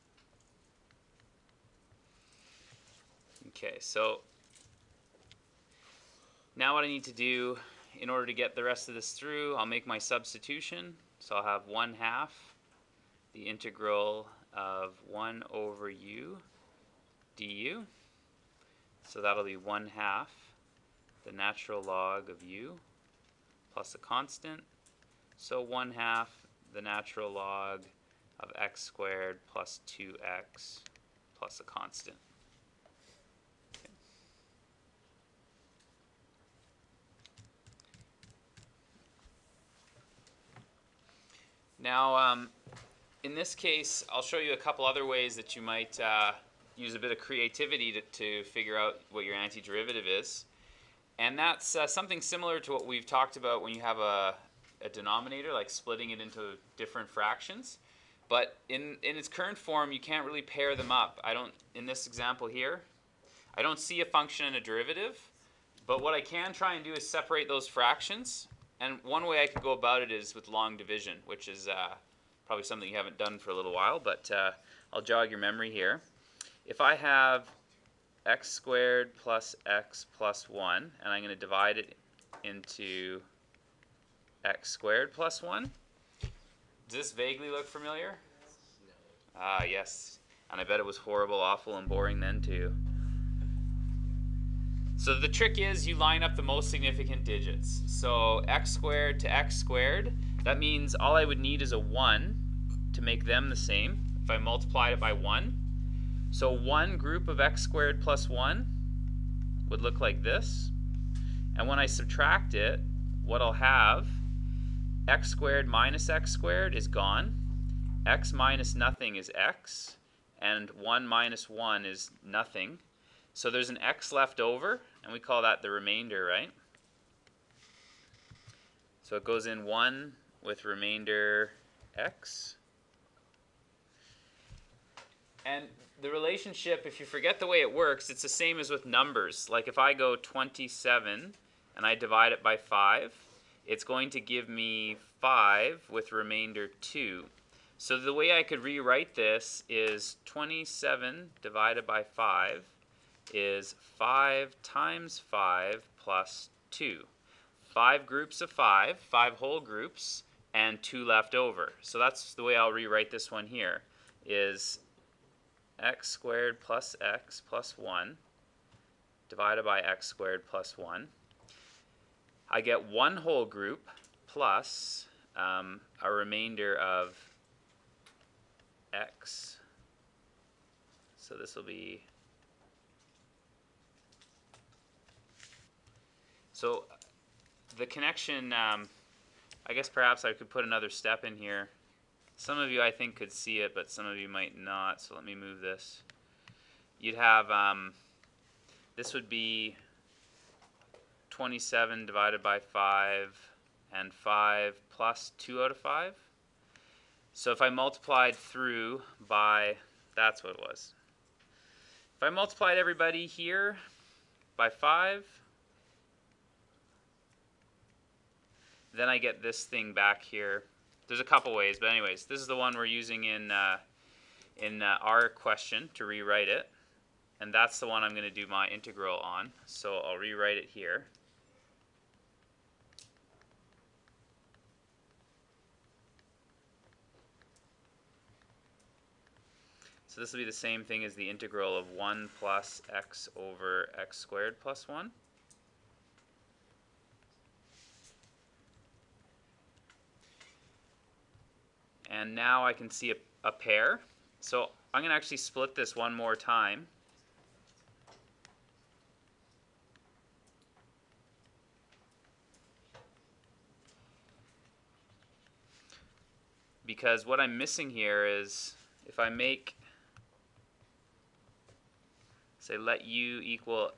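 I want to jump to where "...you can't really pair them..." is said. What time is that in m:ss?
0:59.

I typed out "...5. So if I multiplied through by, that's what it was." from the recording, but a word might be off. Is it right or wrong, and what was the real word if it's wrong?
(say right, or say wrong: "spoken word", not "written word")
right.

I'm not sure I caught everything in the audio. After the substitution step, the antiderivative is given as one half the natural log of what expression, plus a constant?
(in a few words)
x squared plus 2x.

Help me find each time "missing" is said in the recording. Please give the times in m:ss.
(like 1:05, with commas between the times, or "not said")
4:27.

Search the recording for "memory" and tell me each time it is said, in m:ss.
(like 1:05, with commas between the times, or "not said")
1:15.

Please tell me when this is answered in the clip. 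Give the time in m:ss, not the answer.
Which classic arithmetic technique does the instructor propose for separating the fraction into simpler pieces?
1:10.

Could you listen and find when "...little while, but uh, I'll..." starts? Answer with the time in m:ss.
1:13.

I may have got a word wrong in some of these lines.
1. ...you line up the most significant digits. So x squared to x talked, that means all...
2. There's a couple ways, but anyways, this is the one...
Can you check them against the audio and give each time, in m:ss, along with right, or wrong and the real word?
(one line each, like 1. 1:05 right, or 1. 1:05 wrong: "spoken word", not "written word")
1. 1:35 wrong: "squared", not "talked"
2. 3:41 right.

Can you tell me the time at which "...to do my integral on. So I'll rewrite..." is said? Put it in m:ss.
3:48.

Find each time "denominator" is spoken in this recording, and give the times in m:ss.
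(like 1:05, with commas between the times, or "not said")
0:54.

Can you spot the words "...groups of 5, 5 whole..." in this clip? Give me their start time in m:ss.
2:38.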